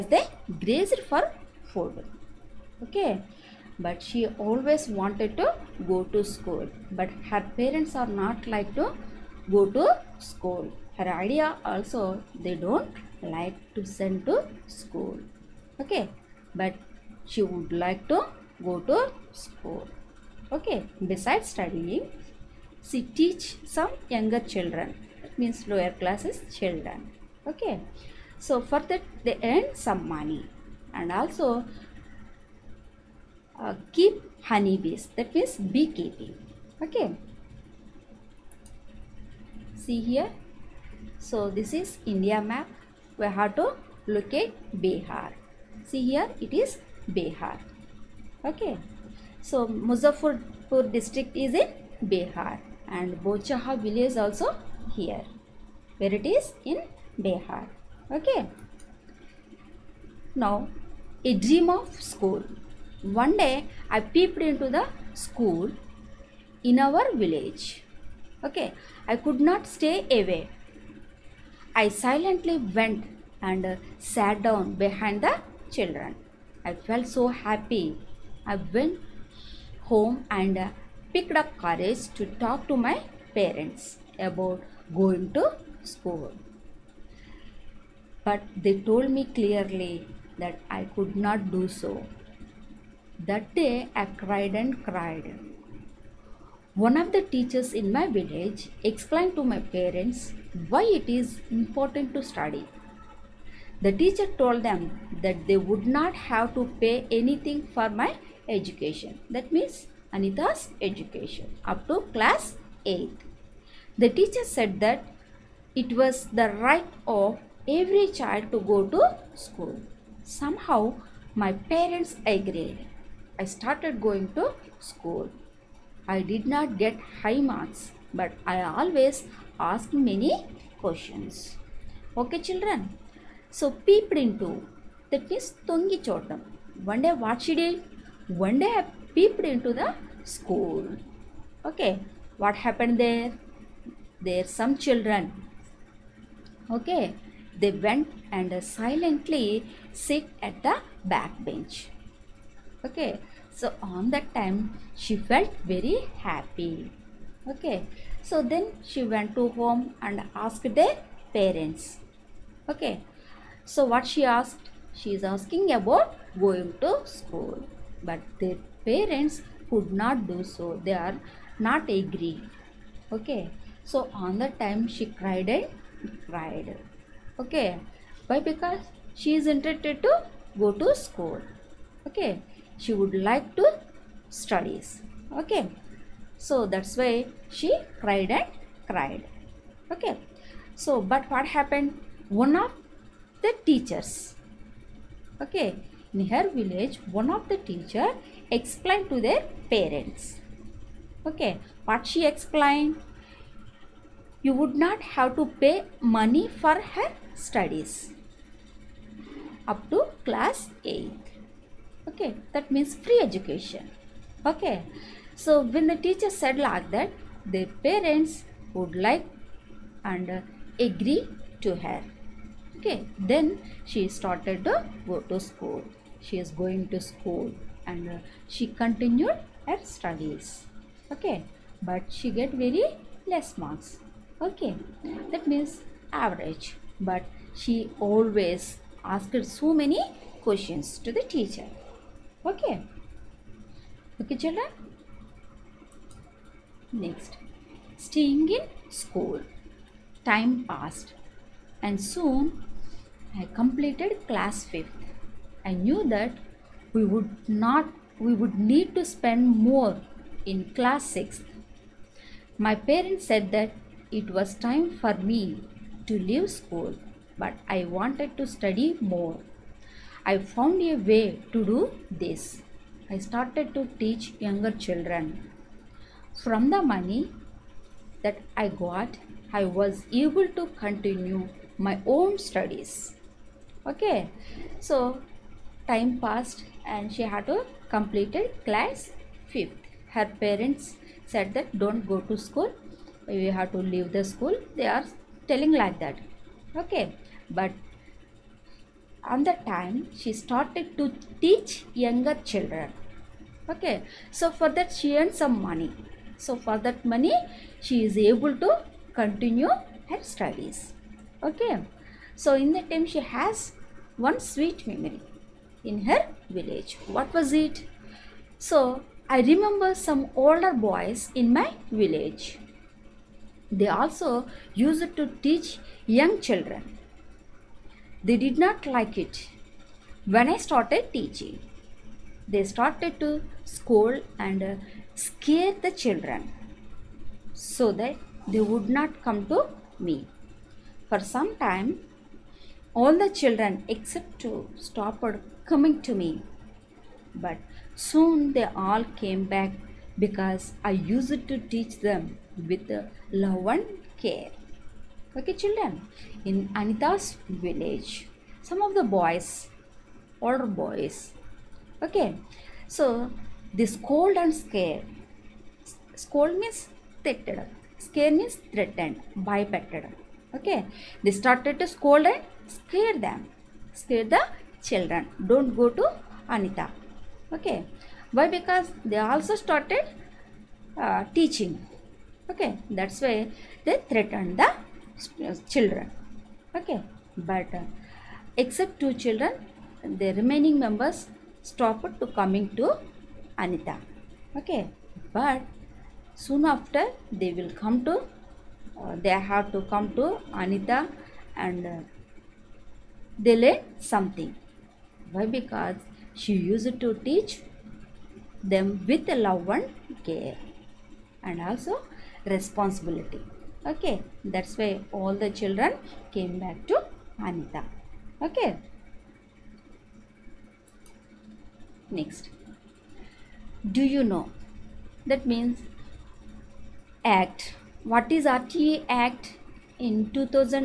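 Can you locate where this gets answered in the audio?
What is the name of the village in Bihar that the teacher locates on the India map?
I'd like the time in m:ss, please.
0:53.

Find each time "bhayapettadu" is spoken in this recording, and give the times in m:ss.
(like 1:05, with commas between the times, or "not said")
6:09.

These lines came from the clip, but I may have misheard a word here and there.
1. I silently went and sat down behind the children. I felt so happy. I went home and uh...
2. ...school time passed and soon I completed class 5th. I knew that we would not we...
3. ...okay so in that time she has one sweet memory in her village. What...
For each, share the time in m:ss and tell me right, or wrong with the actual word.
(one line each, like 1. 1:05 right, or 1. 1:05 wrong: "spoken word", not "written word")
1. 1:11 right
2. 4:09 right
3. 5:11 right.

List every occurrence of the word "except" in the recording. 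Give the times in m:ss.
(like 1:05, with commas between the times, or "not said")
5:43, 6:28.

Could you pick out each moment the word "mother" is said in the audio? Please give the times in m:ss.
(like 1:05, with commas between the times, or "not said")
not said.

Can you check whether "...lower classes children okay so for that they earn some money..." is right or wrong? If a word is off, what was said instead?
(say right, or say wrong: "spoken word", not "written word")
right.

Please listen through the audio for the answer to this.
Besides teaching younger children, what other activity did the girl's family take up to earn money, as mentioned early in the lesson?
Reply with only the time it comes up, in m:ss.
0:35.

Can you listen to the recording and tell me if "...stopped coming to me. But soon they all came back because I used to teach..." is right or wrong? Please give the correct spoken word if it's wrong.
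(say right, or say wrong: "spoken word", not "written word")
right.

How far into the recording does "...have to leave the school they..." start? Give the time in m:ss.
4:53.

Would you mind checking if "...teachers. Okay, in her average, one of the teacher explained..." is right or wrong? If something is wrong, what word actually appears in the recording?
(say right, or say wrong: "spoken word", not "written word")
wrong: "village", not "average".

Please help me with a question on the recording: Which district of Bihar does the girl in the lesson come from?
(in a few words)
Muzaffarpur.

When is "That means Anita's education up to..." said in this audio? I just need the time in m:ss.
1:49.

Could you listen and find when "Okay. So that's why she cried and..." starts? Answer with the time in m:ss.
3:05.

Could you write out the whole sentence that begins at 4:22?
My parents said that it was time for me to leave school but I wanted to study more.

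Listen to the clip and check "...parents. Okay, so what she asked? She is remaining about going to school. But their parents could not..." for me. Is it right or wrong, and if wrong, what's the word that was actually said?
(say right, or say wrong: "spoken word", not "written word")
wrong: "asking", not "remaining".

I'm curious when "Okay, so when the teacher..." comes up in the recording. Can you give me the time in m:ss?
3:34.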